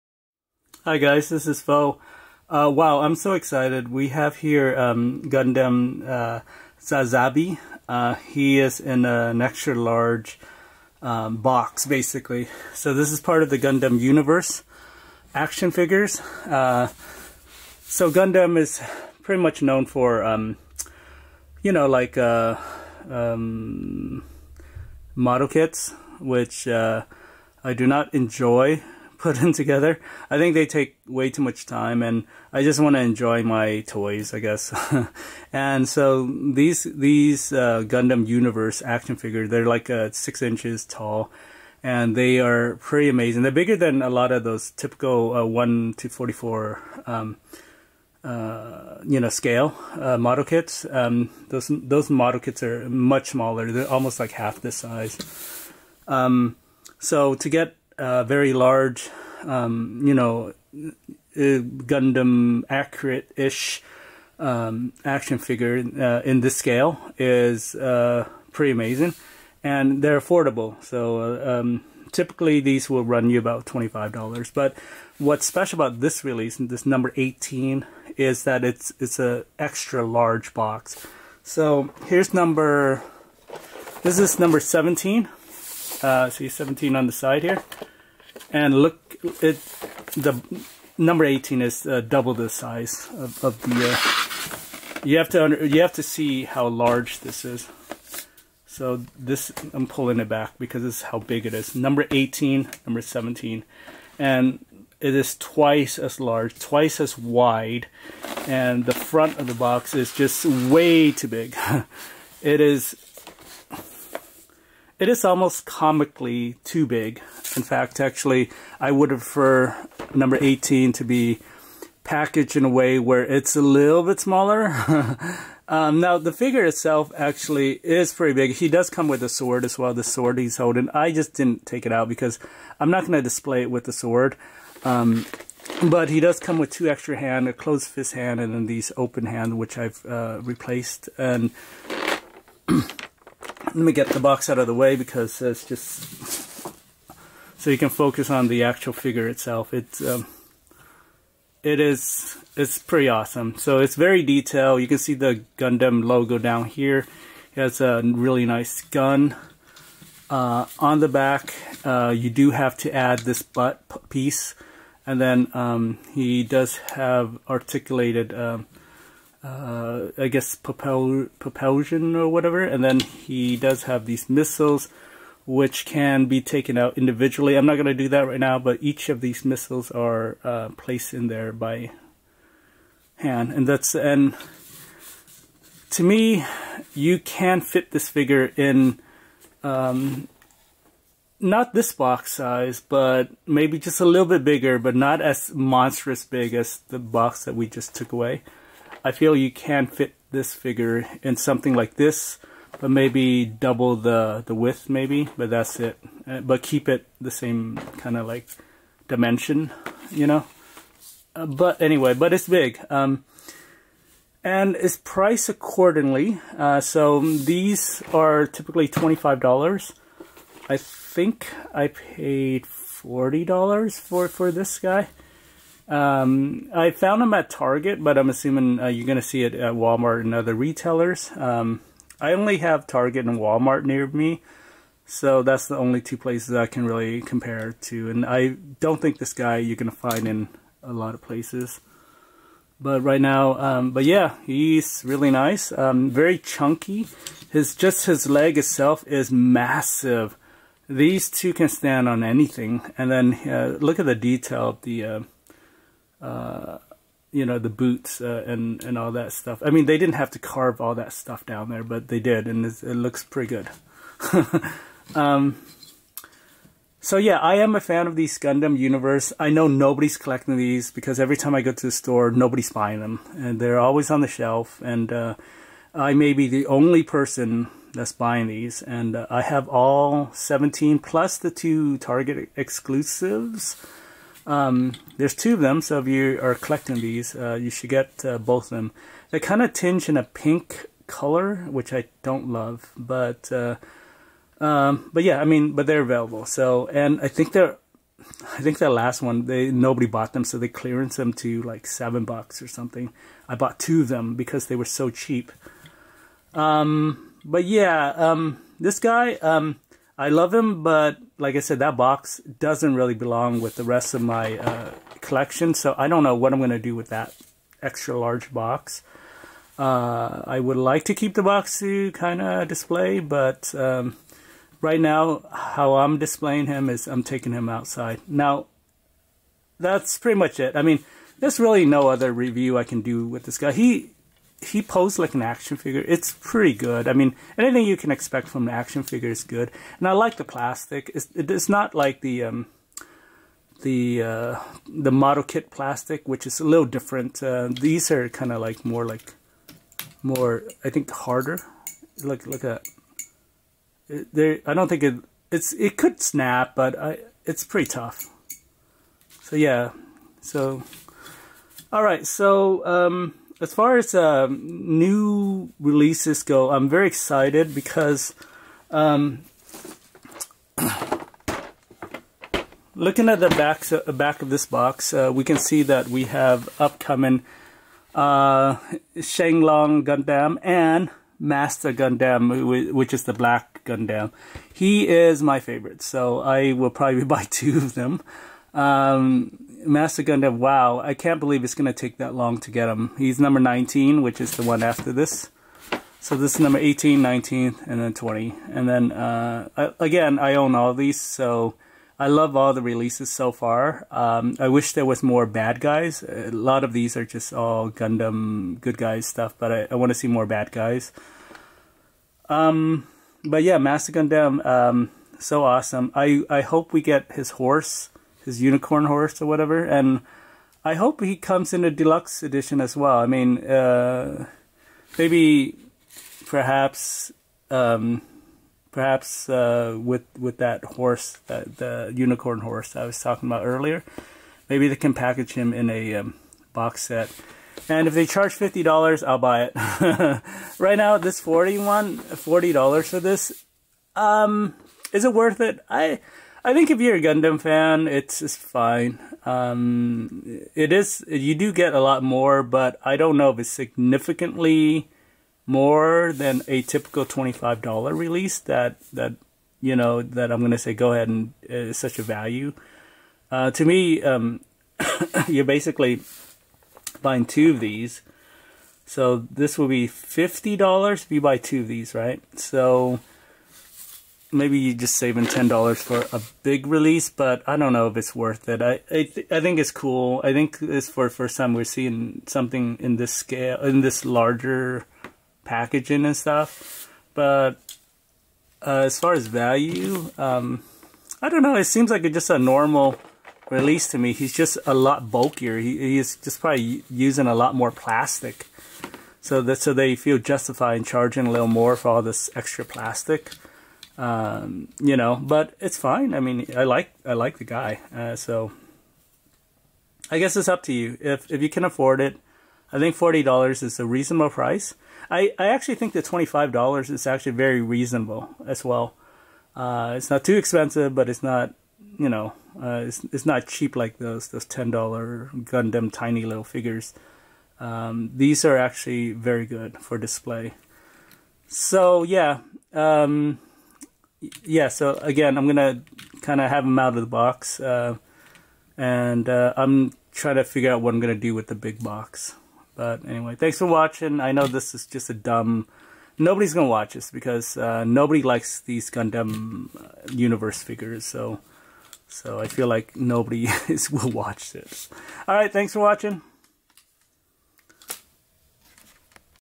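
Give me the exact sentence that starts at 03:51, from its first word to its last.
Um, I only have Target and Walmart near me, so that's the only two places I can really compare to.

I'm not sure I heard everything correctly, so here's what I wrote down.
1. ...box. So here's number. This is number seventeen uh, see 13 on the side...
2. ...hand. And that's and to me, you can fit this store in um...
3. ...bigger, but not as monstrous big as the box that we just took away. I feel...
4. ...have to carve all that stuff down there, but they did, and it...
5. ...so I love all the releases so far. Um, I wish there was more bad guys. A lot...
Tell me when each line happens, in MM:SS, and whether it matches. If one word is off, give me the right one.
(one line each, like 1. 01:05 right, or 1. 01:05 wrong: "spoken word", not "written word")
1. 01:20 wrong: "17", not "13"
2. 03:03 wrong: "figure", not "store"
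3. 03:14 right
4. 04:20 right
5. 06:41 right.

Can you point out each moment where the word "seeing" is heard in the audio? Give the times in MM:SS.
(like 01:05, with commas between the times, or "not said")
08:01.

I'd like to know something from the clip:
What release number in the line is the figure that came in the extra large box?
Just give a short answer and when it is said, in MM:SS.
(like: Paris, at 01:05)
18, at 01:16.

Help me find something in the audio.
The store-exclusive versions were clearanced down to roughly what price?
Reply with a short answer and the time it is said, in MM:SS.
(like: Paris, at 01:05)
$7, at 05:01.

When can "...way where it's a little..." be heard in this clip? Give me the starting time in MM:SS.
02:02.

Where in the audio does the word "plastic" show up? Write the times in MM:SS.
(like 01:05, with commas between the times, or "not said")
05:40, 05:45, 08:17, 08:22.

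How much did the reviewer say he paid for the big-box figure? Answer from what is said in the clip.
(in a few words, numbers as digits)
$40.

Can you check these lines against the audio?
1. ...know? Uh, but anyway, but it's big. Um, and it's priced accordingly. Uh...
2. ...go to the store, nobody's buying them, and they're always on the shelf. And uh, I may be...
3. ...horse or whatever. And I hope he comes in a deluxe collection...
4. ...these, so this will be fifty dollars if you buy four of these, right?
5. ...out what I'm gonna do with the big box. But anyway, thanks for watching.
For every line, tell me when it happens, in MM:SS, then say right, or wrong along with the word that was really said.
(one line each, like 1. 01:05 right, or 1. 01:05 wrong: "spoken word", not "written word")
1. 03:30 right
2. 04:31 right
3. 06:59 wrong: "edition", not "collection"
4. 07:47 wrong: "two", not "four"
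5. 09:00 right.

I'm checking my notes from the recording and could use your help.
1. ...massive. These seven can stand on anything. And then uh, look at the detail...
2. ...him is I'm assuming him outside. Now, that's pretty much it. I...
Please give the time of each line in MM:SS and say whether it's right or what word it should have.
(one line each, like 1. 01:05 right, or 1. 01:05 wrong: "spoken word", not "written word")
1. 04:09 wrong: "two", not "seven"
2. 05:26 wrong: "taking", not "assuming".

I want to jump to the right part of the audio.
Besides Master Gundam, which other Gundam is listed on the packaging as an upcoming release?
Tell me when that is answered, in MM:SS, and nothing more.
06:19.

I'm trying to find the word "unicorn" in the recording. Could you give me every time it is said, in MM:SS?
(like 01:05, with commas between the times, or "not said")
06:58, 07:12.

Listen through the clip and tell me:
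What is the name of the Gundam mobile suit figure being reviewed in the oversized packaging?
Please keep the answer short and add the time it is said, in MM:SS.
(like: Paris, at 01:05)
Sazabi, at 00:06.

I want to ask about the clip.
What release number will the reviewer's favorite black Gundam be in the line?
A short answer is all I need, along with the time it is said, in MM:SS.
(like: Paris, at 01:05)
19, at 06:33.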